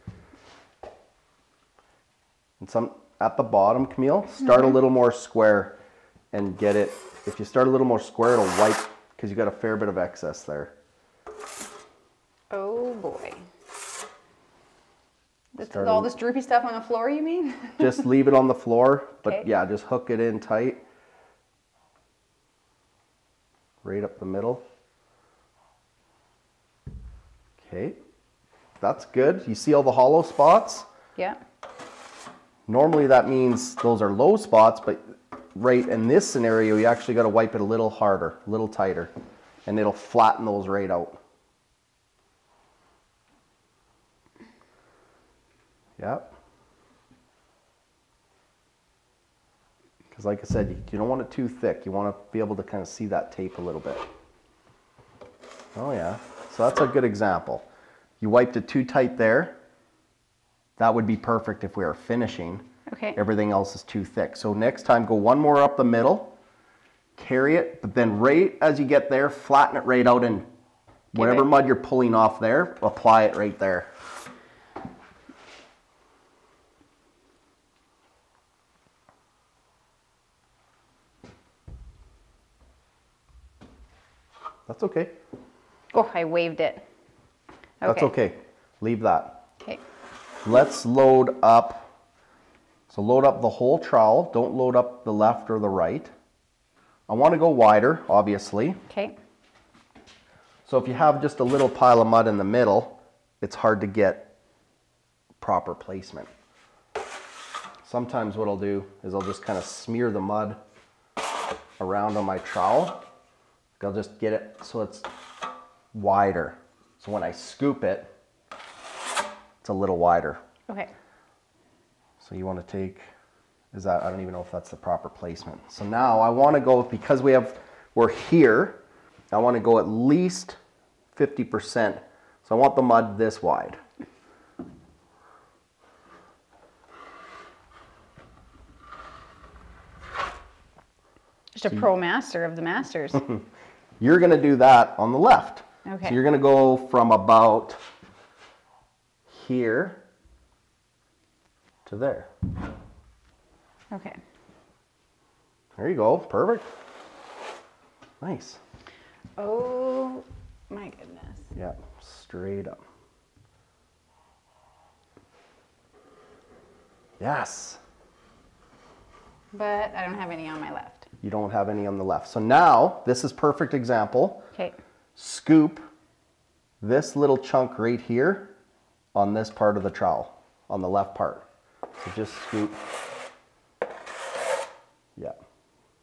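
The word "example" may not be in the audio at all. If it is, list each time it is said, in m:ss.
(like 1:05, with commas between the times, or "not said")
0:57, 2:53.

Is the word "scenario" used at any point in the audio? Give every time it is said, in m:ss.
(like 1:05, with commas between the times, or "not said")
0:36.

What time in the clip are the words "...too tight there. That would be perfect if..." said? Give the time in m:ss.
0:58.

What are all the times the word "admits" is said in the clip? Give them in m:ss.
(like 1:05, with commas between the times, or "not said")
not said.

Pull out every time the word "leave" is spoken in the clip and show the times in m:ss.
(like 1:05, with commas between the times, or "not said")
0:18, 1:28.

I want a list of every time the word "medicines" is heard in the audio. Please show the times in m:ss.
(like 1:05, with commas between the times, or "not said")
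not said.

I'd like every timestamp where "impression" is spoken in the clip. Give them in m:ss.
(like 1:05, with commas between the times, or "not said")
not said.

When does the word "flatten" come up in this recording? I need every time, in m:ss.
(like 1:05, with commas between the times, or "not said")
0:39, 1:09.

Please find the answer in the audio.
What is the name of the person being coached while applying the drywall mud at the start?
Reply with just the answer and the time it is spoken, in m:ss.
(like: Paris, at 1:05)
Camille, at 0:03.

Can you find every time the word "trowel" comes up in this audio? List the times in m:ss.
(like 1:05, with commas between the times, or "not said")
1:33, 1:52, 2:59.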